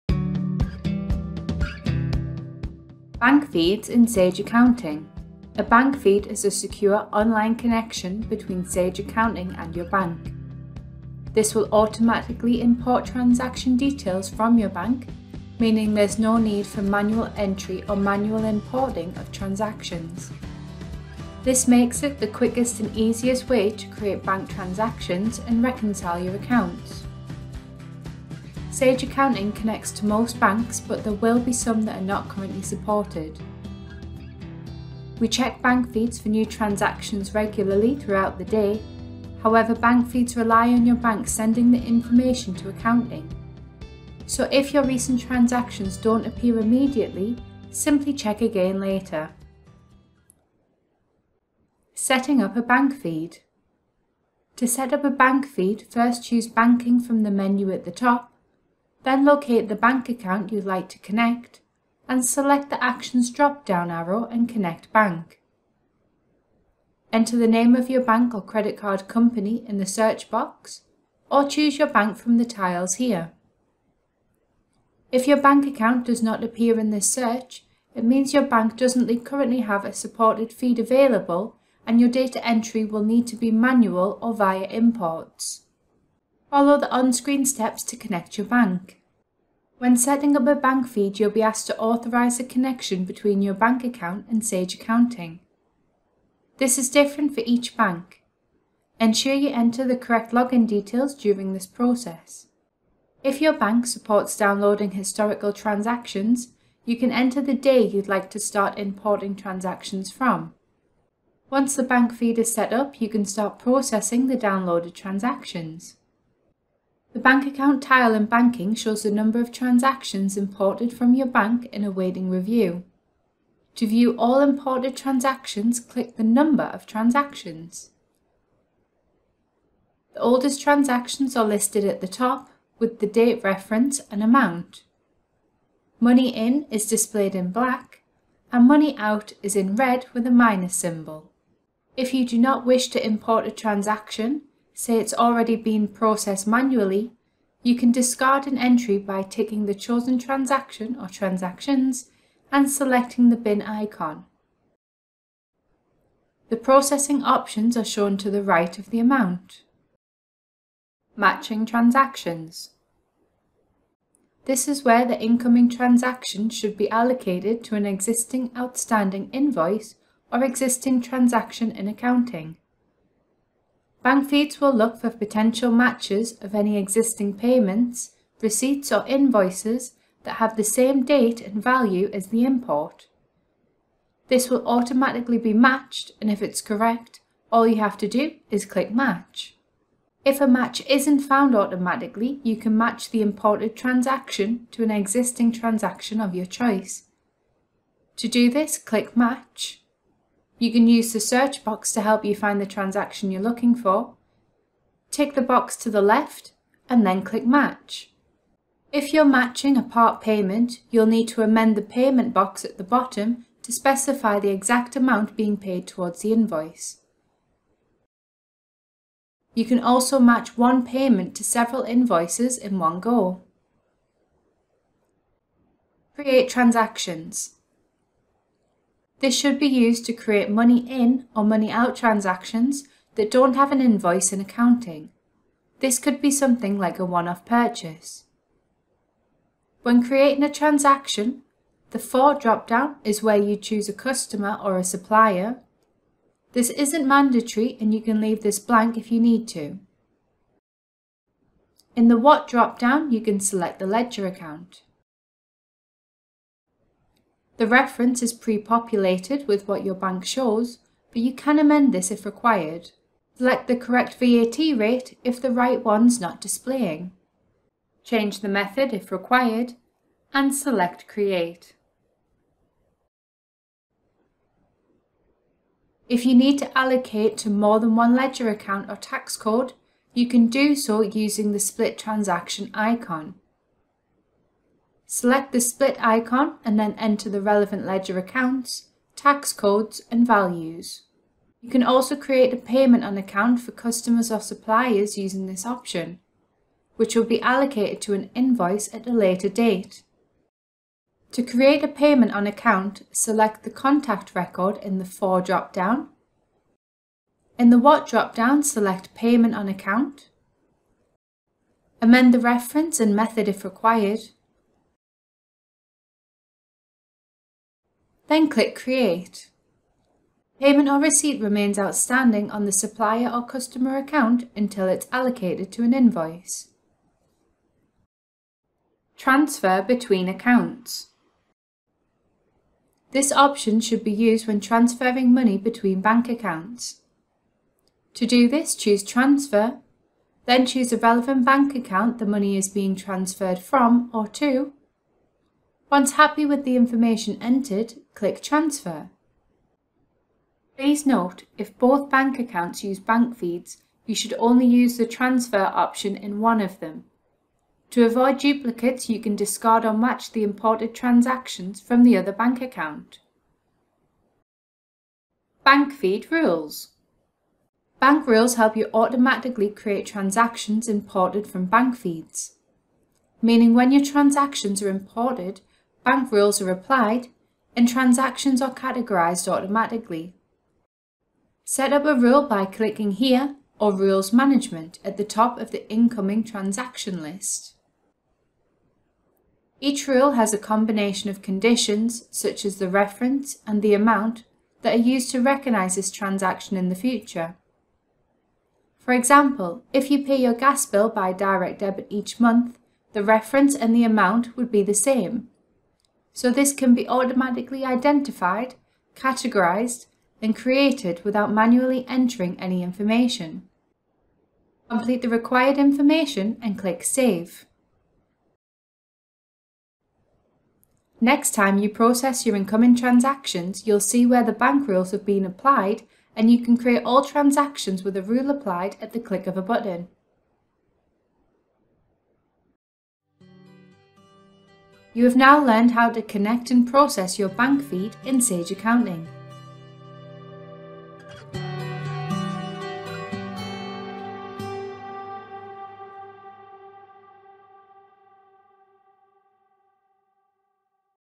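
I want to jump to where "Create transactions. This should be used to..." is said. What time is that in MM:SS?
03:46.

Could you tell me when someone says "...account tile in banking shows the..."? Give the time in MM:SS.
01:57.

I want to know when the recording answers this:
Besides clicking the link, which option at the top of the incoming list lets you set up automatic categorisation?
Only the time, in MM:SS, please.
06:23.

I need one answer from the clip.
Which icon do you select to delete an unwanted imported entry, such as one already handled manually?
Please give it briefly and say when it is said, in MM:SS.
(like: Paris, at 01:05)
Bin icon, at 02:33.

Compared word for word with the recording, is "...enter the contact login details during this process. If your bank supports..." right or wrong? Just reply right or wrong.
wrong.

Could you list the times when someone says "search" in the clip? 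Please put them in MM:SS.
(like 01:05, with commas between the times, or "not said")
01:09, 01:17, 03:21.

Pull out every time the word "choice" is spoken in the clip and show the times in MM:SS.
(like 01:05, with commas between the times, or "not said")
03:16.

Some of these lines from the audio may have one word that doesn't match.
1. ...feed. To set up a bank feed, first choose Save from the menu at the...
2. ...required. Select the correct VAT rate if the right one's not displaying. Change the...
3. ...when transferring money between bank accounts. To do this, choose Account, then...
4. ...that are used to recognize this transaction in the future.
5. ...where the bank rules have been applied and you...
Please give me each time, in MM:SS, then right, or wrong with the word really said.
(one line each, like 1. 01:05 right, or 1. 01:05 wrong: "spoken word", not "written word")
1. 00:52 wrong: "Banking", not "Save"
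2. 04:22 right
3. 05:34 wrong: "Transfer", not "Account"
4. 06:34 right
5. 07:04 right.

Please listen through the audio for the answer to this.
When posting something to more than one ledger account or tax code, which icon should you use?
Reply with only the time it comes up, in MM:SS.
04:41.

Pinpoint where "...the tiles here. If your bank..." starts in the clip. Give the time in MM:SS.
01:12.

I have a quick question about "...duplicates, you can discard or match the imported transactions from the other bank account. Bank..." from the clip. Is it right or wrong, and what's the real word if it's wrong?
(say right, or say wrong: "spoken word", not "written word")
right.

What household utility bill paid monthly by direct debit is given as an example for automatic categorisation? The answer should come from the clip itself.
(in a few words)
Gas bill.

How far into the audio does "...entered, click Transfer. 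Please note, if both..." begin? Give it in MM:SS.
05:47.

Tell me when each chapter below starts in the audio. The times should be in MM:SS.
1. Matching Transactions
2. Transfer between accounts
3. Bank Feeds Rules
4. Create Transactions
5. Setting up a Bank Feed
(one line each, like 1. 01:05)
1. 02:41
2. 05:30
3. 06:05
4. 03:46
5. 00:51.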